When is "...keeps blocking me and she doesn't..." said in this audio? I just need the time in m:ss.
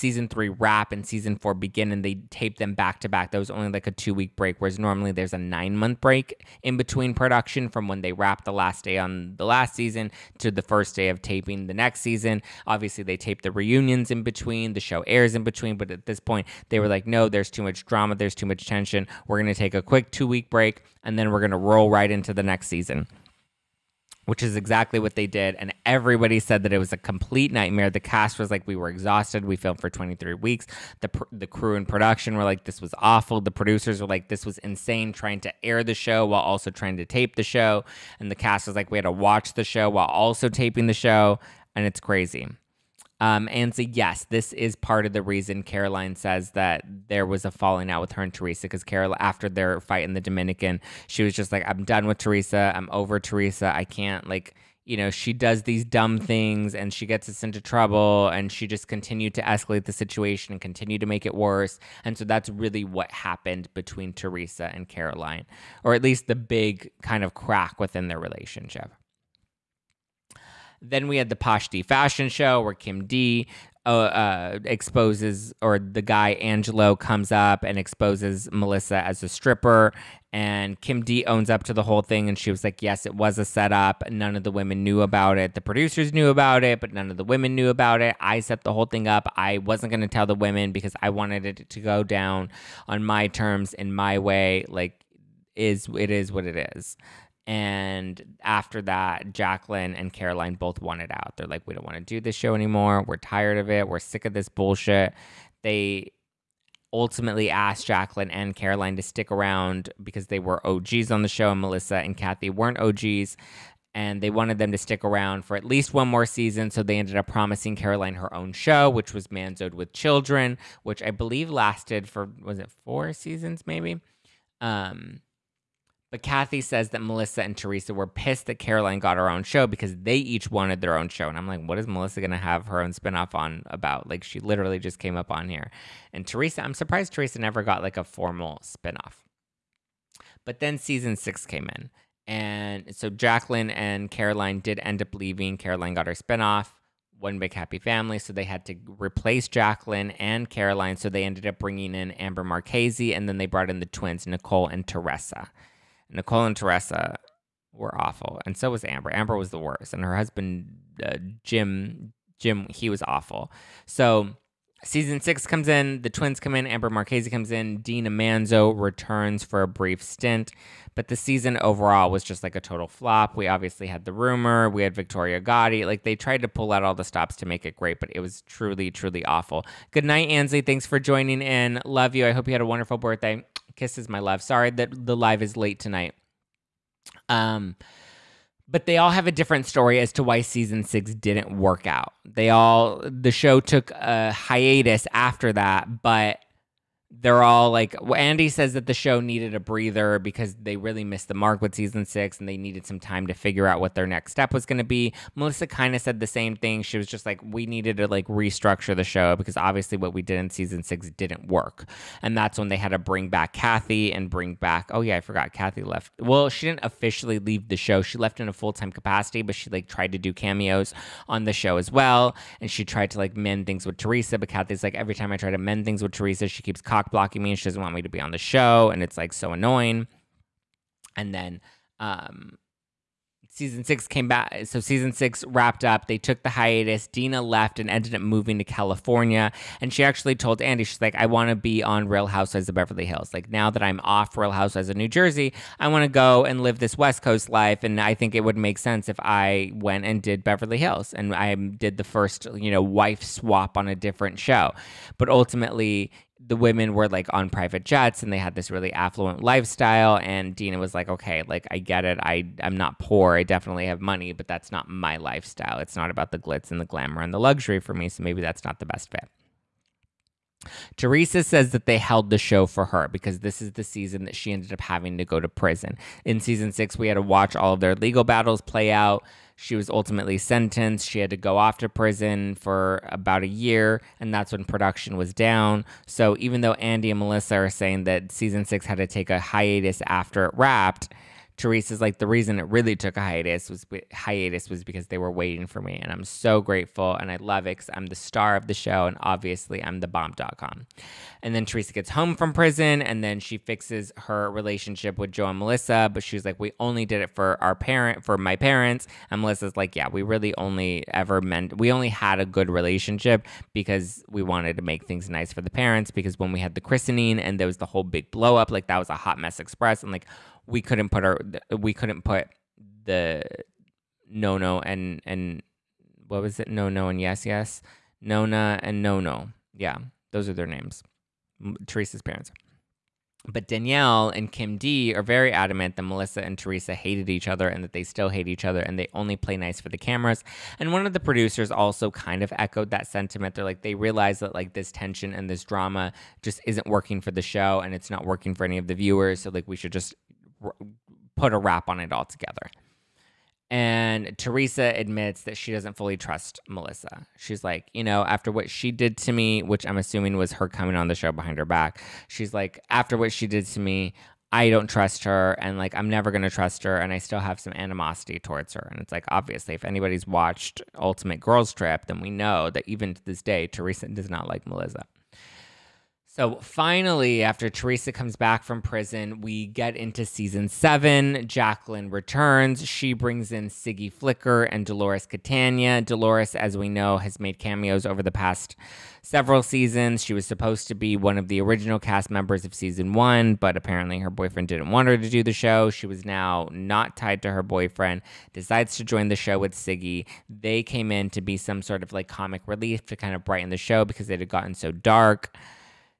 3:46.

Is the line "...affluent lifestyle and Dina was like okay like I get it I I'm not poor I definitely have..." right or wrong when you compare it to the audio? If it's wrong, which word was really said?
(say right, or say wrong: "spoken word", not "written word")
right.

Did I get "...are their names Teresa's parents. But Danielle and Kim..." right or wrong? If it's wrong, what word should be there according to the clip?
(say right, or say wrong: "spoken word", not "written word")
right.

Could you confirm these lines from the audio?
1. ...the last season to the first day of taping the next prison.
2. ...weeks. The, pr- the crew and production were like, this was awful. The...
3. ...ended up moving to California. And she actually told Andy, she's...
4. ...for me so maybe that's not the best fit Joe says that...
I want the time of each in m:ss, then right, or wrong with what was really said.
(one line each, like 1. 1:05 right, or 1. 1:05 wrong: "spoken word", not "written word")
1. 0:09 wrong: "season", not "prison"
2. 0:30 right
3. 3:57 right
4. 4:27 wrong: "Teresa", not "Joe".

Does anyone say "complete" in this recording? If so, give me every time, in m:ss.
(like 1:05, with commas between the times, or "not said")
0:26.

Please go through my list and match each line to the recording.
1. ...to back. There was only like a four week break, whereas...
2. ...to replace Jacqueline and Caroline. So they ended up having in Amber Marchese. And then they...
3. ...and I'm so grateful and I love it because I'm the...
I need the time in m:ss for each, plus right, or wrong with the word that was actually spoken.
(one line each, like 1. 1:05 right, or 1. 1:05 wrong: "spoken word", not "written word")
1. 0:03 wrong: "two", not "four"
2. 2:28 wrong: "bringing", not "having"
3. 4:56 right.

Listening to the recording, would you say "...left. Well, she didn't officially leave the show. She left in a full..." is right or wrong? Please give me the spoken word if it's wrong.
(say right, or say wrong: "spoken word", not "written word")
right.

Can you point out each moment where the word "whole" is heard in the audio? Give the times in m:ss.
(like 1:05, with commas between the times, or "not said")
1:21, 1:28, 5:17.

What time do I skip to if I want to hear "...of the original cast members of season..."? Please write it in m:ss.
6:31.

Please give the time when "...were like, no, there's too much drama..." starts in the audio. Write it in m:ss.
0:16.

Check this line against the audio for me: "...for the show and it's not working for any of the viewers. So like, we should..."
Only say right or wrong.
right.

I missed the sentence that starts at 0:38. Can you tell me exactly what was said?
And the cast was like, we had to watch the show while also taping the show.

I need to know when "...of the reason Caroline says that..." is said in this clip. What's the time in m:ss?
0:45.